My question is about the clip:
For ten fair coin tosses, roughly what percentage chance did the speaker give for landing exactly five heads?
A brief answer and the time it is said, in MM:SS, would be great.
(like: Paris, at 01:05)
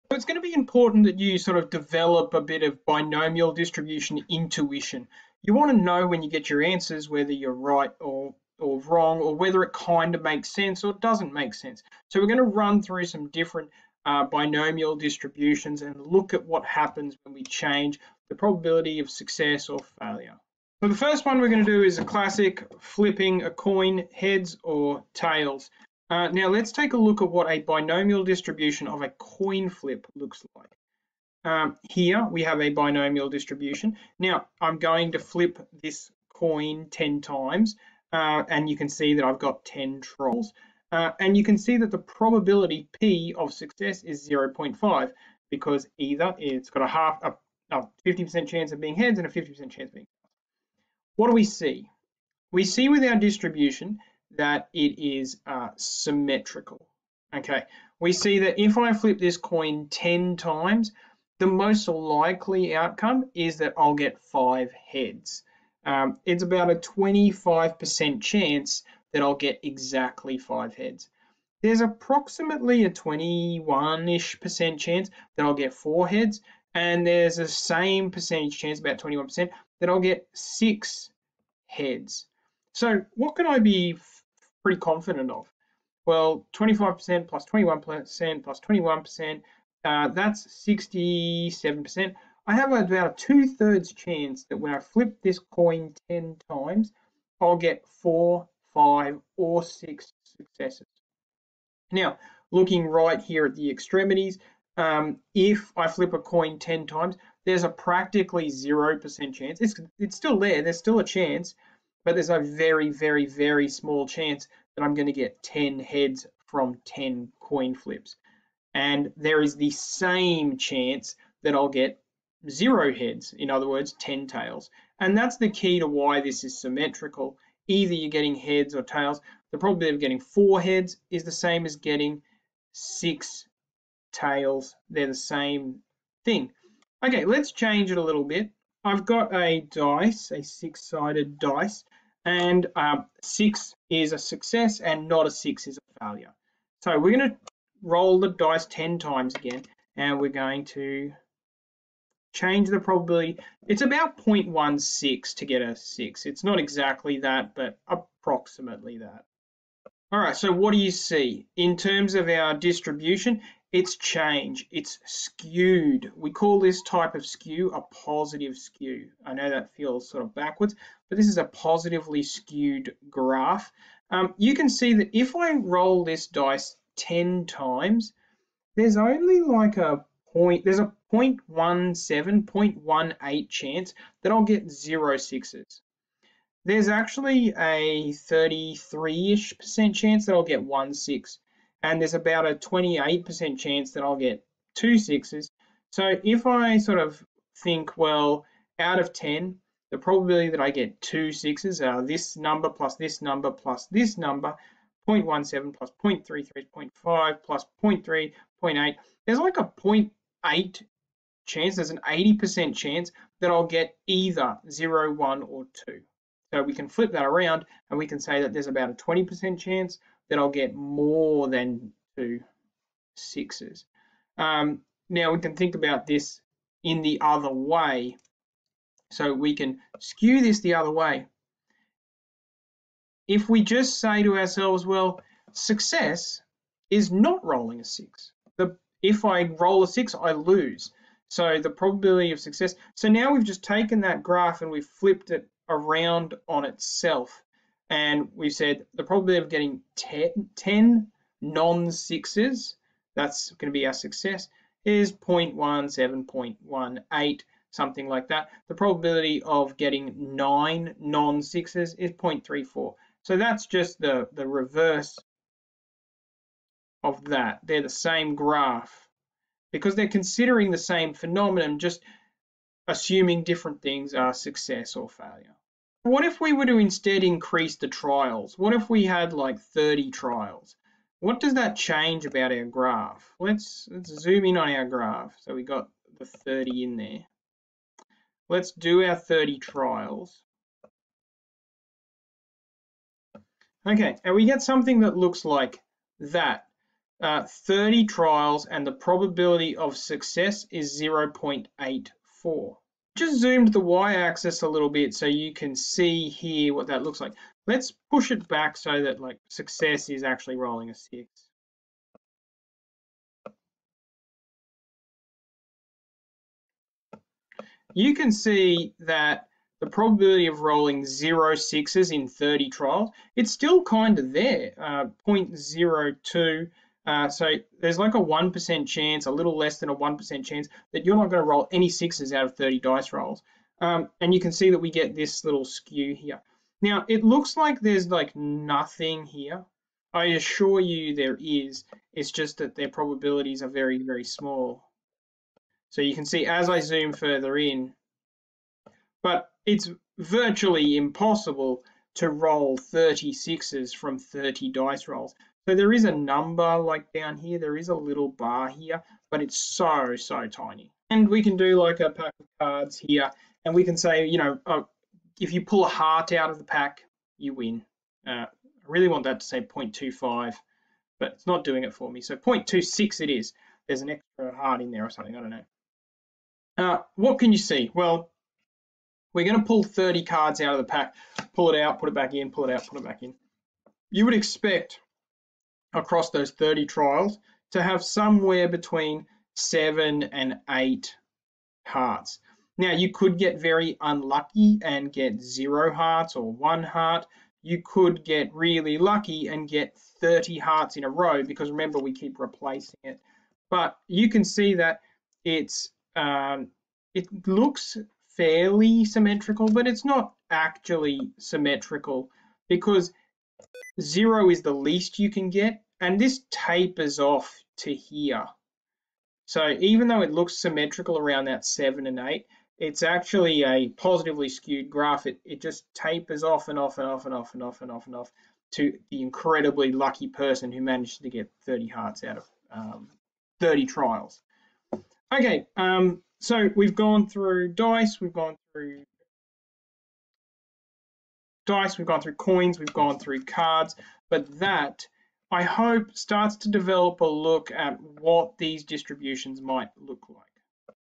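25%, at 01:06.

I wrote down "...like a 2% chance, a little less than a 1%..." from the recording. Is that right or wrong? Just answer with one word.
wrong.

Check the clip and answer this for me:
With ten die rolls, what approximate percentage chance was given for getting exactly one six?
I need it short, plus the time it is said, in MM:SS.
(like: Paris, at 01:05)
33%, at 03:08.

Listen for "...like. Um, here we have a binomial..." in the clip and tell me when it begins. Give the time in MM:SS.
00:30.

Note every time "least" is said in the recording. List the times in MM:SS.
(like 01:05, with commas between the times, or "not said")
06:54.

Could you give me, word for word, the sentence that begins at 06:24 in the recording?
You would expect across those 30 trials to have somewhere between seven and eight hearts.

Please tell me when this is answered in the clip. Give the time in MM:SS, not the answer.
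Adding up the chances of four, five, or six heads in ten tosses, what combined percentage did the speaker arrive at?
01:30.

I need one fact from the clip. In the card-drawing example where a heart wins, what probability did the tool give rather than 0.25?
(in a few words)
0.26.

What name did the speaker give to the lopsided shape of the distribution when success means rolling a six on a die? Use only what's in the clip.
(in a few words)
positive skew.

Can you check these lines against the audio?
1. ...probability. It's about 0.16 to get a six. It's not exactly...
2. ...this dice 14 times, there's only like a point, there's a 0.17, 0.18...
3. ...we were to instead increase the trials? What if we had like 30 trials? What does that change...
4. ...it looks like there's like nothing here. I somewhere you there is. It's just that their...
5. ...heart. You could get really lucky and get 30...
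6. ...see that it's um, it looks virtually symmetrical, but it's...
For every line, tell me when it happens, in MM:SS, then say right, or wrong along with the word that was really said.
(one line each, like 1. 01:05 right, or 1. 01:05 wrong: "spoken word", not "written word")
1. 02:32 right
2. 02:56 wrong: "10", not "14"
3. 04:36 right
4. 05:37 wrong: "assure", not "somewhere"
5. 06:36 right
6. 06:44 wrong: "fairly", not "virtually".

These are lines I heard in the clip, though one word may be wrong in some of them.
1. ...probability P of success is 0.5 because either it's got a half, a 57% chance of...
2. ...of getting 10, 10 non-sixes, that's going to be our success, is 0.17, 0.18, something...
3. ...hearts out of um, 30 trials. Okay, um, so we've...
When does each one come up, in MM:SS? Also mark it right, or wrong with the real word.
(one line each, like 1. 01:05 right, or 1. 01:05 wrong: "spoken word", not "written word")
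1. 00:41 wrong: "50", not "57"
2. 04:09 right
3. 07:11 right.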